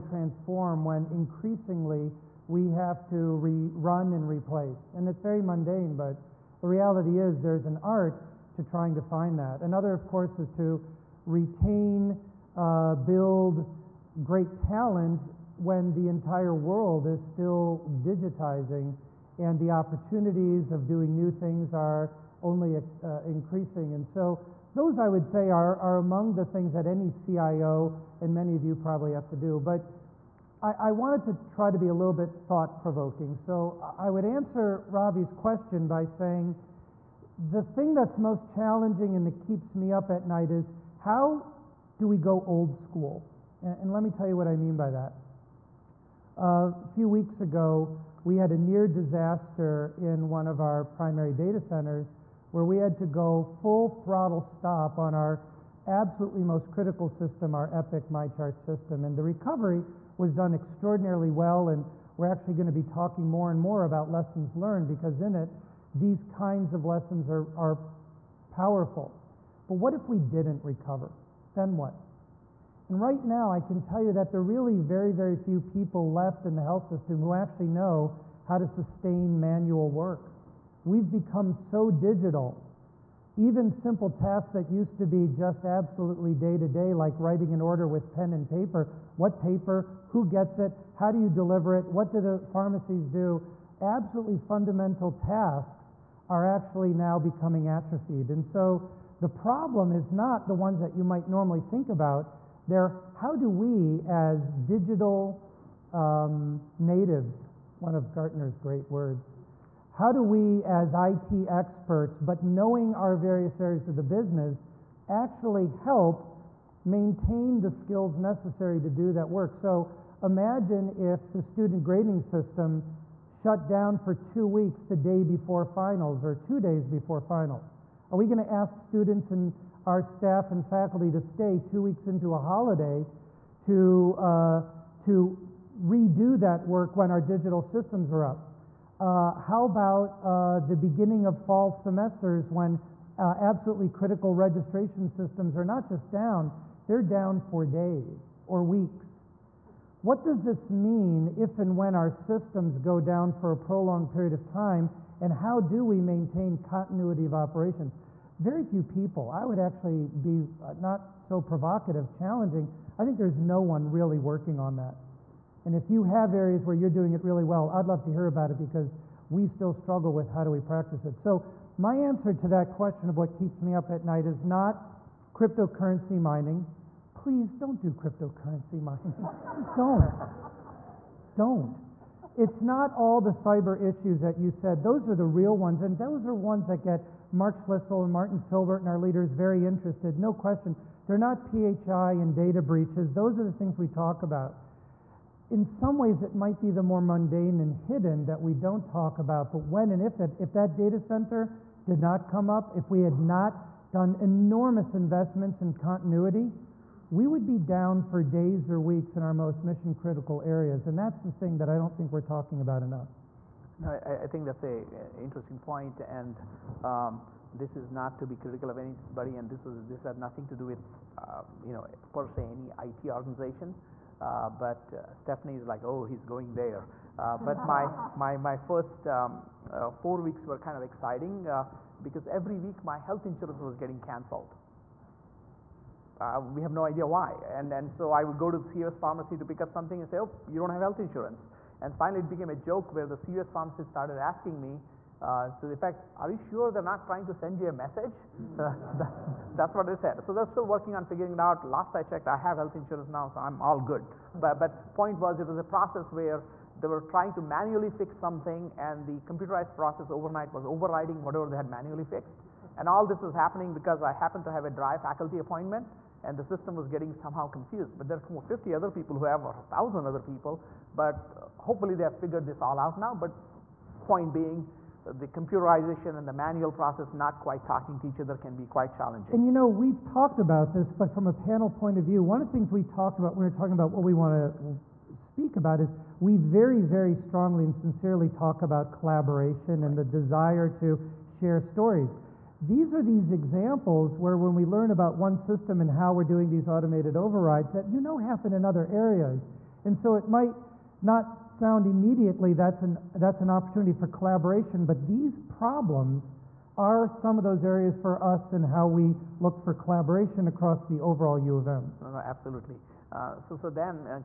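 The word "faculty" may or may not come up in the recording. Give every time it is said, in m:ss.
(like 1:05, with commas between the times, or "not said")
2:10, 4:24.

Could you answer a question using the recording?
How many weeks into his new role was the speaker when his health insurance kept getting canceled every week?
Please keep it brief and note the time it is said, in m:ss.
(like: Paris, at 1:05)
4, at 3:49.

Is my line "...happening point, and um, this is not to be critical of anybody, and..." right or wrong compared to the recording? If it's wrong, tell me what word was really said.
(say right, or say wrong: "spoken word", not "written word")
wrong: "interesting", not "happening".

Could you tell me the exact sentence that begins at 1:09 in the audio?
But what if we didn't recover?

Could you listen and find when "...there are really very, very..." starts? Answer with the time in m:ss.
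1:14.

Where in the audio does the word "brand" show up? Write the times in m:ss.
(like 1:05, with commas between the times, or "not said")
not said.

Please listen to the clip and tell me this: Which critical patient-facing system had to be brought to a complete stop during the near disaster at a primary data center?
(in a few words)
Epic MyChart.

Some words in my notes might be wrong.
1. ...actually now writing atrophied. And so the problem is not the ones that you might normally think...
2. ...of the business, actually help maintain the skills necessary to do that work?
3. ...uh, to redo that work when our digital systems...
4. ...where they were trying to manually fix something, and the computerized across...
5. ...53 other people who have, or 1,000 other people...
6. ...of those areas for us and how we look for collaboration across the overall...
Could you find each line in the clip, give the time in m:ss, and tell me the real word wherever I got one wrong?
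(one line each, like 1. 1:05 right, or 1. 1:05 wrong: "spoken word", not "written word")
1. 1:36 wrong: "becoming", not "writing"
2. 1:53 right
3. 2:14 right
4. 4:16 wrong: "process", not "across"
5. 4:28 wrong: "50", not "53"
6. 5:07 right.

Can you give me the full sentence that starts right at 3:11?
They're not PHI and data breaches.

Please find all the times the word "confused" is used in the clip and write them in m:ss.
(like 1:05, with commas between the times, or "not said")
4:27.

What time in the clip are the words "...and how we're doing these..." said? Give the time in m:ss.
4:55.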